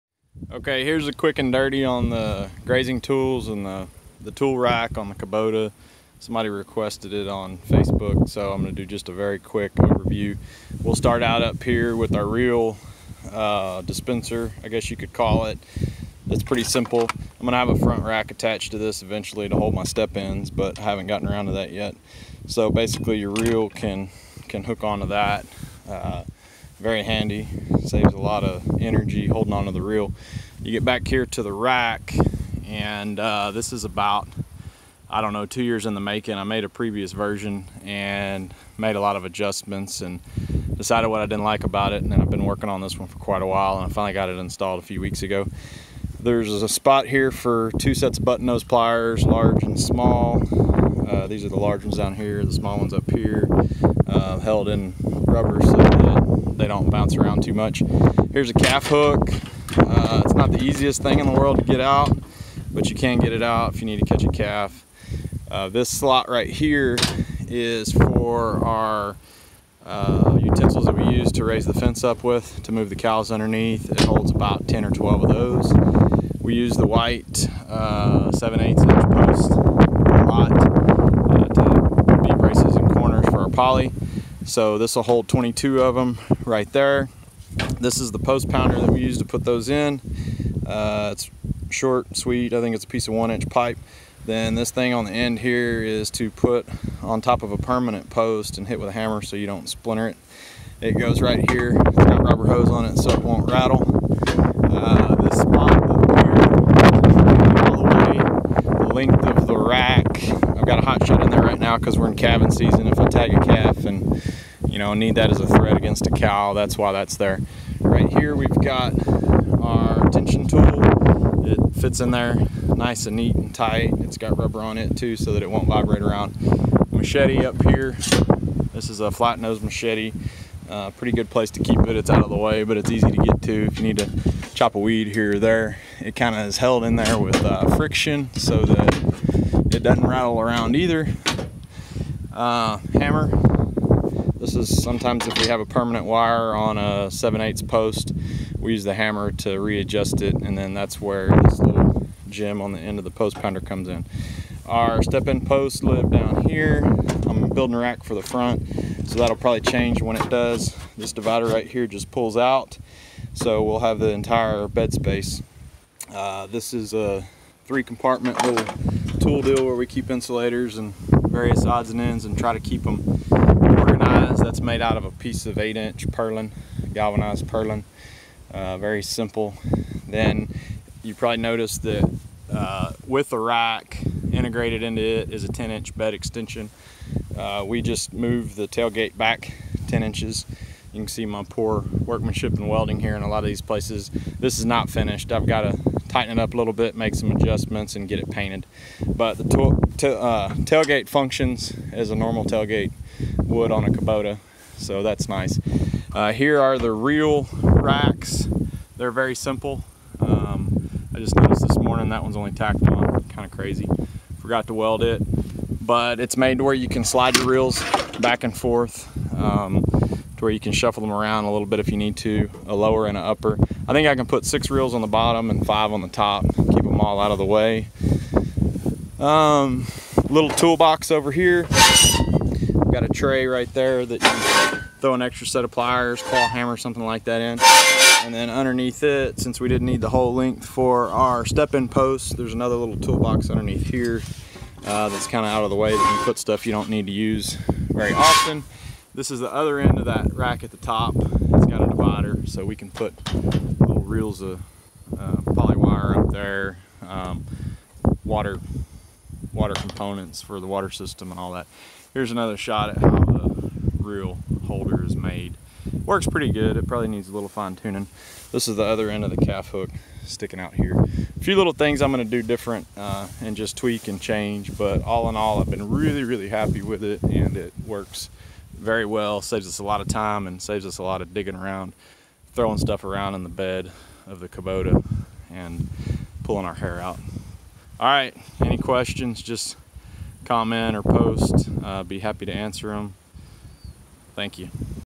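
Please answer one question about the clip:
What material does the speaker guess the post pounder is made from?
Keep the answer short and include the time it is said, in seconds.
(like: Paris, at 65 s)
1-inch pipe, at 93 s.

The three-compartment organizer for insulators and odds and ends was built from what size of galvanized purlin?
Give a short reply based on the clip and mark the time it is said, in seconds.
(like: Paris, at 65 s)
8-inch, at 175 s.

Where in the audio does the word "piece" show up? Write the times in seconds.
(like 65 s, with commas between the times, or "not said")
92 s, 175 s.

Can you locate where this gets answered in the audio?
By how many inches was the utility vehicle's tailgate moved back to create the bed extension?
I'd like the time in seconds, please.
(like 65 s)
189 s.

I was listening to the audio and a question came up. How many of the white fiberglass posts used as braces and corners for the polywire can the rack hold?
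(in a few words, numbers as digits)
22.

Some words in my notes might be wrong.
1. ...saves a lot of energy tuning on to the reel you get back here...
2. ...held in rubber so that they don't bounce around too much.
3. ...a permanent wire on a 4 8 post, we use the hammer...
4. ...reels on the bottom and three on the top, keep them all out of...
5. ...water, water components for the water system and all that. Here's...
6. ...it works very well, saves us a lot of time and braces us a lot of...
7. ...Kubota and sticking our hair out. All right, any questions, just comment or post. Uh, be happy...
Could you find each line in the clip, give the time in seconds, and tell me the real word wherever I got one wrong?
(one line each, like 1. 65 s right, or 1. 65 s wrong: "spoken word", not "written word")
1. 27 s wrong: "holding", not "tuning"
2. 54 s right
3. 145 s wrong: "7", not "4"
4. 224 s wrong: "five", not "three"
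5. 258 s right
6. 277 s wrong: "saves", not "braces"
7. 284 s wrong: "pulling", not "sticking".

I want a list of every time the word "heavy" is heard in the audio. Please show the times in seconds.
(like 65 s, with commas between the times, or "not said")
not said.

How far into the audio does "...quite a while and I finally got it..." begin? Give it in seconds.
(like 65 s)
43 s.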